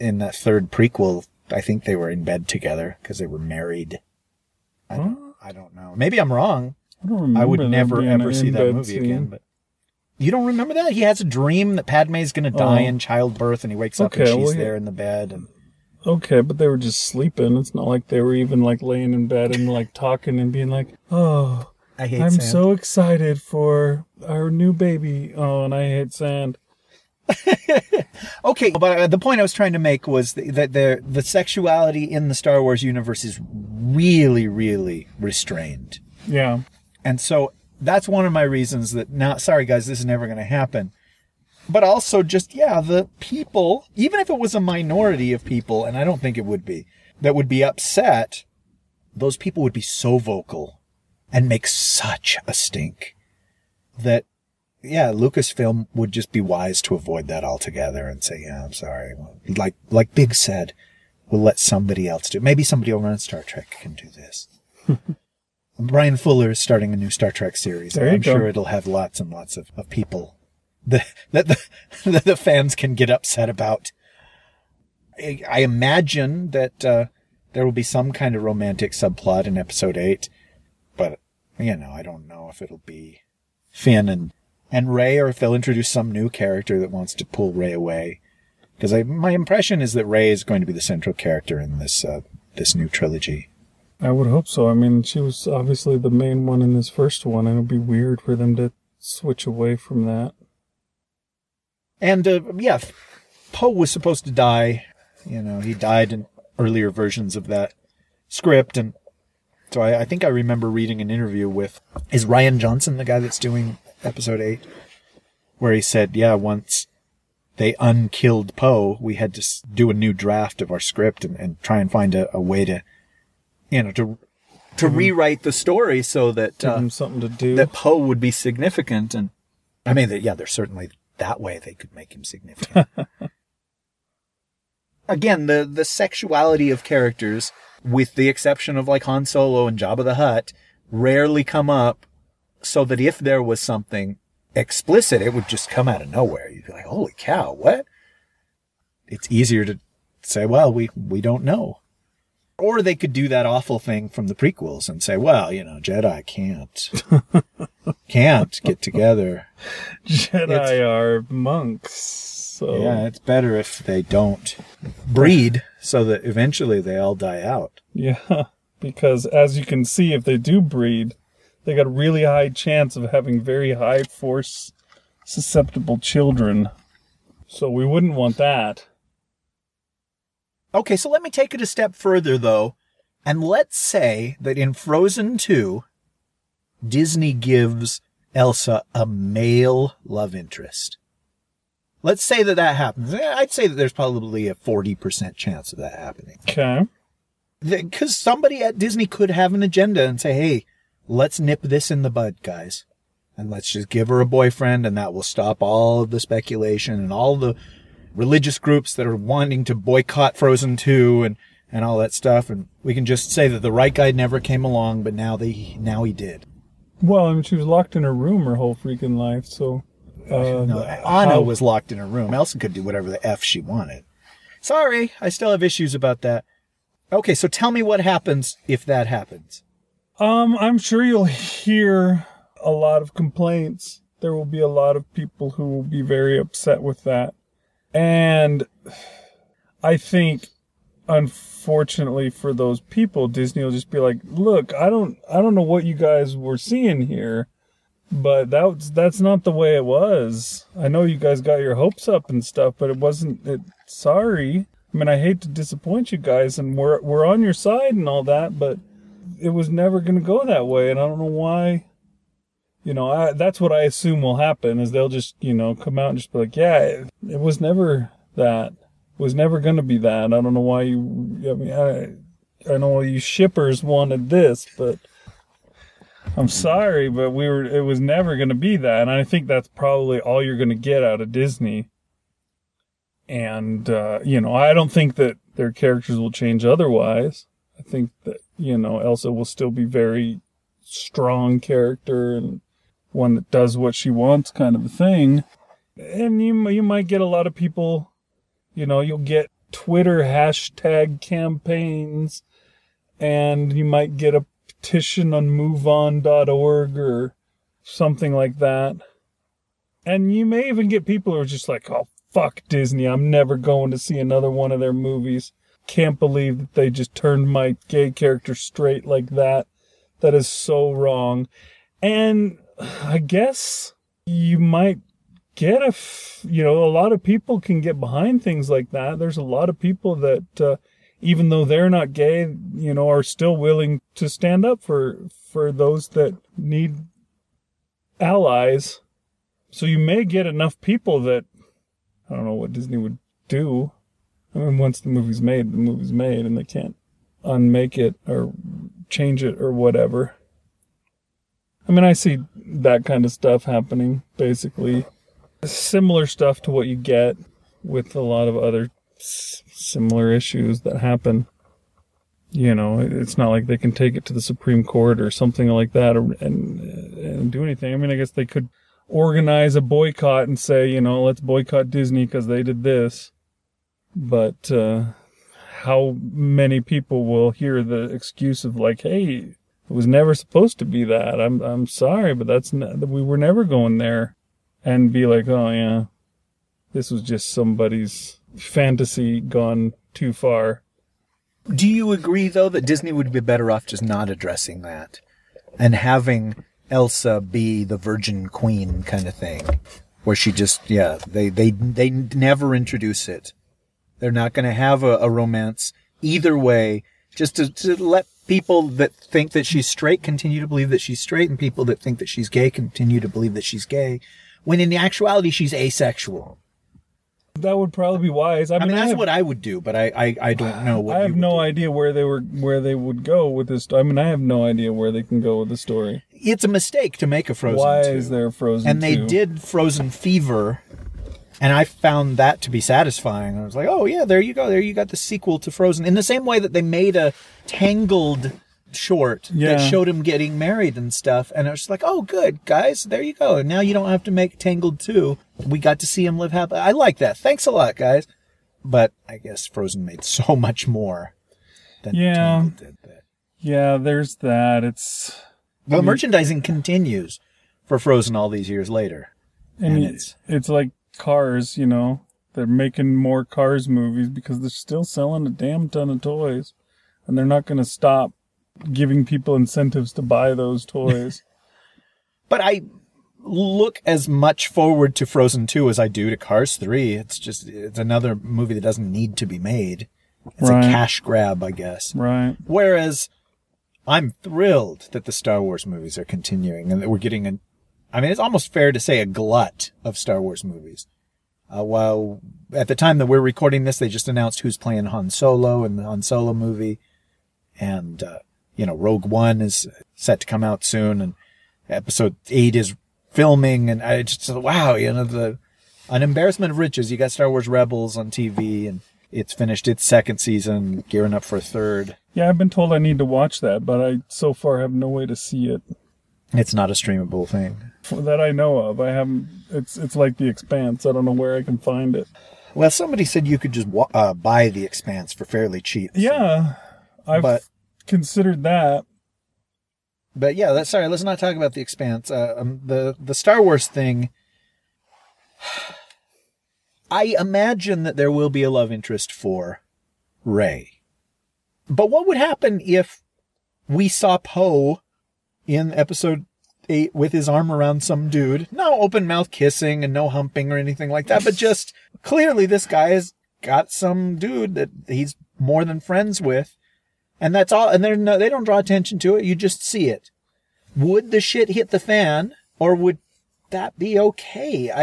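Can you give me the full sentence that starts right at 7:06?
It's a mistake to make a Frozen.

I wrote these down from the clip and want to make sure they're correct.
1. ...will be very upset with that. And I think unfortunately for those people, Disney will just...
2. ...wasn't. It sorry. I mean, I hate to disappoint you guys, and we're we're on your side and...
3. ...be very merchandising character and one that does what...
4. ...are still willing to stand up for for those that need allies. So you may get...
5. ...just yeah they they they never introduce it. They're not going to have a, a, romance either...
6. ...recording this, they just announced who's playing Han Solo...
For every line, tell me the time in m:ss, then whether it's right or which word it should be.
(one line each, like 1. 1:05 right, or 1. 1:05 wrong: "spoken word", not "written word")
1. 3:55 right
2. 4:12 right
3. 4:49 wrong: "strong", not "merchandising"
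4. 5:33 right
5. 6:40 right
6. 8:13 right.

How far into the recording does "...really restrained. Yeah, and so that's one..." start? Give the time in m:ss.
0:34.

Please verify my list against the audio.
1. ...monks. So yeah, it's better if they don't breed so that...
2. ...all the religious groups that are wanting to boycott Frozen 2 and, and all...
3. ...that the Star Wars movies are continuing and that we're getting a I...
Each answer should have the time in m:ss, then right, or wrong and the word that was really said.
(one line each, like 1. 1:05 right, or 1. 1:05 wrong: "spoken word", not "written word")
1. 2:41 right
2. 3:27 right
3. 8:05 right.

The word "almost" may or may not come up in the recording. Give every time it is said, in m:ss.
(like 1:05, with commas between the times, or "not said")
8:08.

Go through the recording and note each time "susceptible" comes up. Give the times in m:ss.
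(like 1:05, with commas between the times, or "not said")
2:55.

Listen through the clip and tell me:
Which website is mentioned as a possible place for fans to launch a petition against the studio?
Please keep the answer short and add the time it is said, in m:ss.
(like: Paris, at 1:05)
moveon.org, at 5:05.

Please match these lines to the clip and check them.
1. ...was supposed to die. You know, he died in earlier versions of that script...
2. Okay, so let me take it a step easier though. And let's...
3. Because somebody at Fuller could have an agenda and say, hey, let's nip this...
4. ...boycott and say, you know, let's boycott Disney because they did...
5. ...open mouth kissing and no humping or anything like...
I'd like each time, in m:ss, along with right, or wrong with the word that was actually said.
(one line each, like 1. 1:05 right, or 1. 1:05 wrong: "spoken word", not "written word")
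1. 1:43 right
2. 3:00 wrong: "further", not "easier"
3. 3:17 wrong: "Disney", not "Fuller"
4. 6:09 right
5. 9:08 right.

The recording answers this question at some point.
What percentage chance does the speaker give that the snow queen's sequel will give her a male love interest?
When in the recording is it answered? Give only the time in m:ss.
3:14.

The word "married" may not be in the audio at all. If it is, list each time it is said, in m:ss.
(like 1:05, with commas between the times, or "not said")
0:03, 7:20.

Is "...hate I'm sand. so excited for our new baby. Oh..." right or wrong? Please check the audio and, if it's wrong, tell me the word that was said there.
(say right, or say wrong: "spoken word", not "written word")
right.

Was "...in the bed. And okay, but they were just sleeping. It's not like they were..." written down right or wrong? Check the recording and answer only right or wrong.
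right.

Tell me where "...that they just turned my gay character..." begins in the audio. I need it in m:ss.
5:16.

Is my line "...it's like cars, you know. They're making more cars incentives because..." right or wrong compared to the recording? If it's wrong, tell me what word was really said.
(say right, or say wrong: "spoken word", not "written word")
wrong: "movies", not "incentives".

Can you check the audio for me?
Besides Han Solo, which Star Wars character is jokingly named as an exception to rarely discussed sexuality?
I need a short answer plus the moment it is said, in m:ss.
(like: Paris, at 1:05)
Jabba the Hutt, at 2:19.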